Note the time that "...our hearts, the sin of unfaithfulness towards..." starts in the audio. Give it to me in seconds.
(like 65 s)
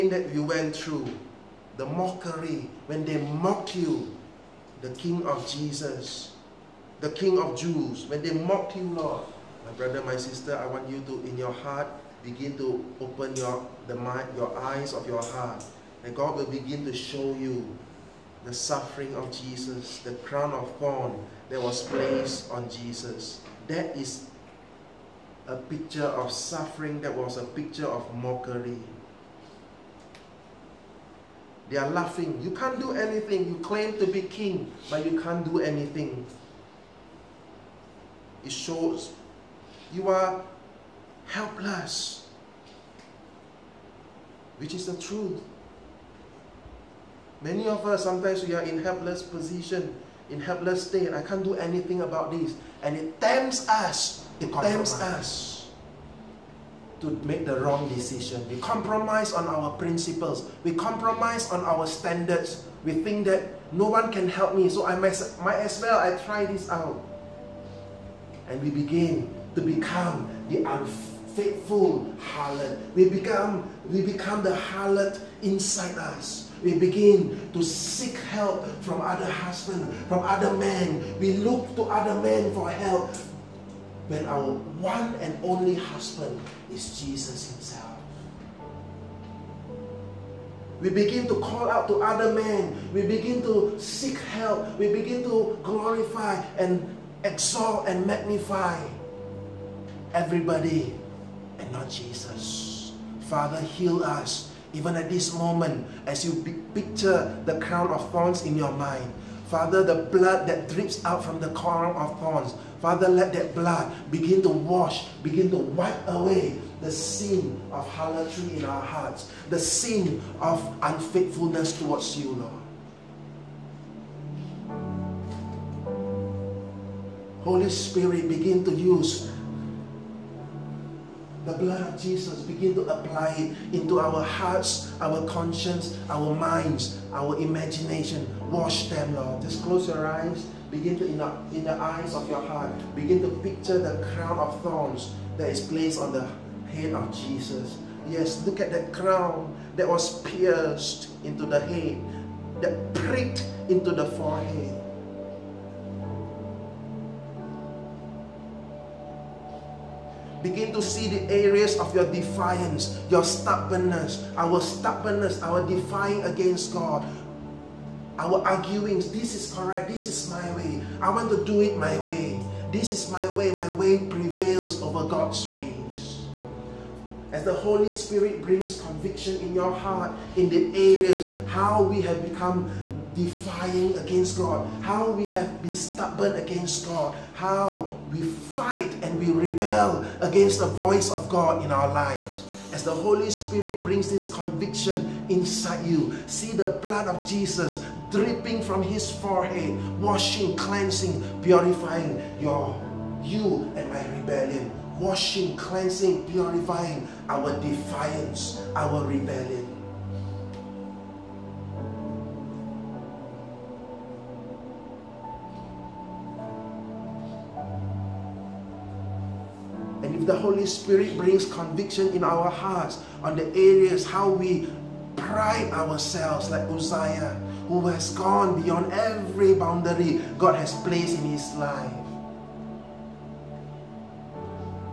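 118 s.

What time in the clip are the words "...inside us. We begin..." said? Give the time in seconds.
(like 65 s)
75 s.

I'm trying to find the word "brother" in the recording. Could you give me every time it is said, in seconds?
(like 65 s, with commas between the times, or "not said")
9 s.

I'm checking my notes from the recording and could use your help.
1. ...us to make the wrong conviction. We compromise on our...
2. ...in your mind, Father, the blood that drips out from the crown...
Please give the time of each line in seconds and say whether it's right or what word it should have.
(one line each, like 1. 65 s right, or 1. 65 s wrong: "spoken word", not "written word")
1. 55 s wrong: "decision", not "conviction"
2. 108 s right.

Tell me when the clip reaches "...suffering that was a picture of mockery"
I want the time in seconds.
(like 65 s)
26 s.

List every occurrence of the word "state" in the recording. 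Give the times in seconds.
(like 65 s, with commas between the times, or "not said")
50 s.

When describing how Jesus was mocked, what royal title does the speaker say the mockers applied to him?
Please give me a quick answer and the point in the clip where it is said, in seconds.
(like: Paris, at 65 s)
King of Jews, at 7 s.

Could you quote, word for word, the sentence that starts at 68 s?
And we begin to become the unfaithful harlot.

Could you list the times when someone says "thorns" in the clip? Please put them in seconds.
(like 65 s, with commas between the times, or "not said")
20 s, 108 s, 112 s, 144 s.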